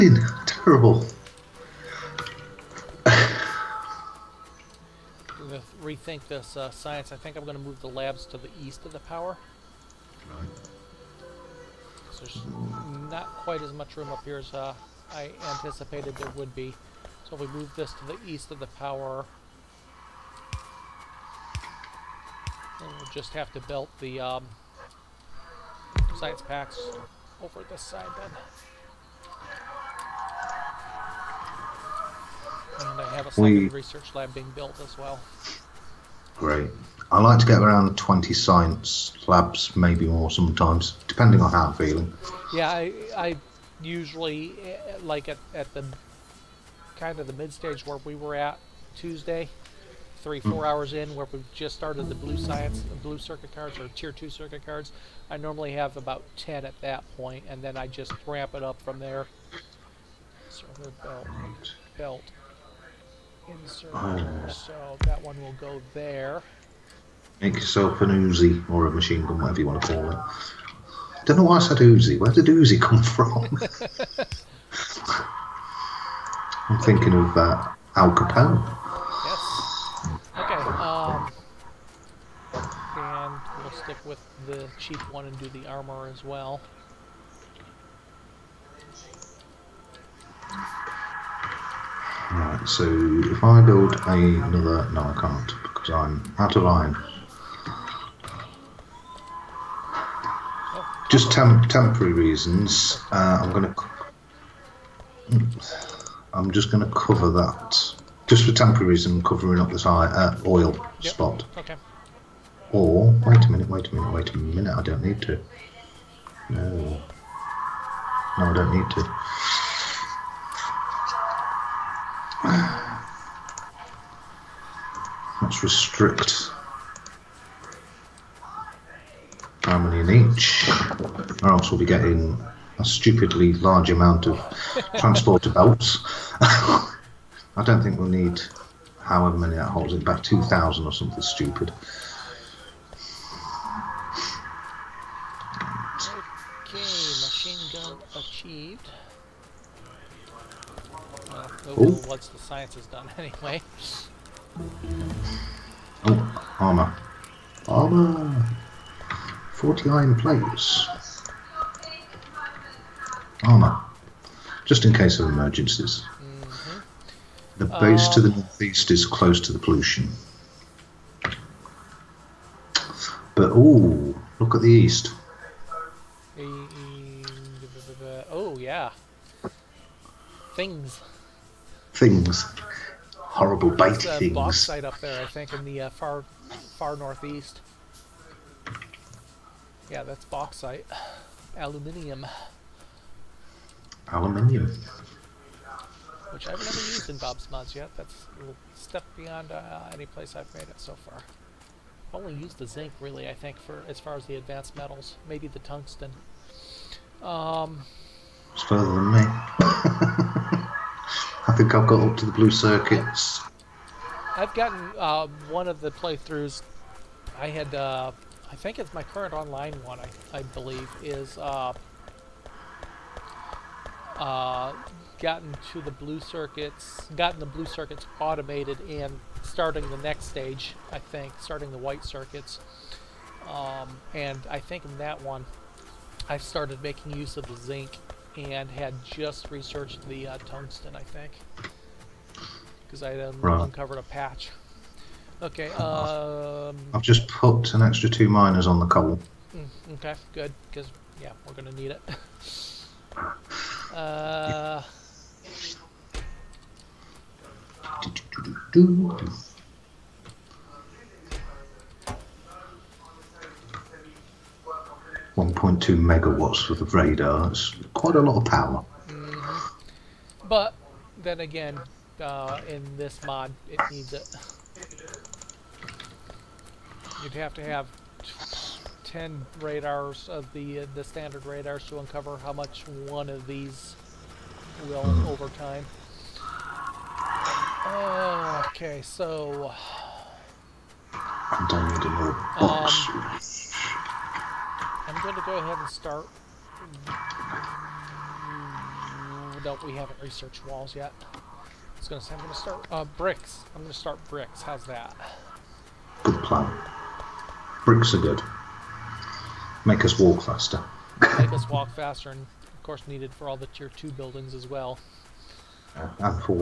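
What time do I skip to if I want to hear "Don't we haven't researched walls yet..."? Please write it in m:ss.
4:59.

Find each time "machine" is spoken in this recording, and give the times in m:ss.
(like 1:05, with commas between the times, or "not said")
1:08, 2:26.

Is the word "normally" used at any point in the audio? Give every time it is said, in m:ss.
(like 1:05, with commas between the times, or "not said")
0:55.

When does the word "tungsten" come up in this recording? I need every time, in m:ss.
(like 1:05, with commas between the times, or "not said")
3:25, 4:00.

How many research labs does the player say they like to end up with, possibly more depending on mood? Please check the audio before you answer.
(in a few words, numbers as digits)
20.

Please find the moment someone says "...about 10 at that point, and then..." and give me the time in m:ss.
0:55.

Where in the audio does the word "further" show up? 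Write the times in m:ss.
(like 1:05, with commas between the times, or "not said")
3:28.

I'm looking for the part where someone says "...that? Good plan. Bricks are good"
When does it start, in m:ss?
5:04.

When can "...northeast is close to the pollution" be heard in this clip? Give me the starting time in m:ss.
2:48.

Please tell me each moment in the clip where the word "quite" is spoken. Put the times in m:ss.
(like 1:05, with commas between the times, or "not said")
0:13, 4:27.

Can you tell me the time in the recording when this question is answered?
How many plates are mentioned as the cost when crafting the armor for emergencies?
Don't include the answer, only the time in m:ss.
2:39.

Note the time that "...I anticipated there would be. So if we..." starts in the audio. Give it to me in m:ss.
0:15.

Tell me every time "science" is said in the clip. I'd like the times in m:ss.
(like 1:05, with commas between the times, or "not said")
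0:06, 0:26, 0:38, 0:52, 2:32.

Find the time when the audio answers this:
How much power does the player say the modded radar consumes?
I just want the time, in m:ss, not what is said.
4:25.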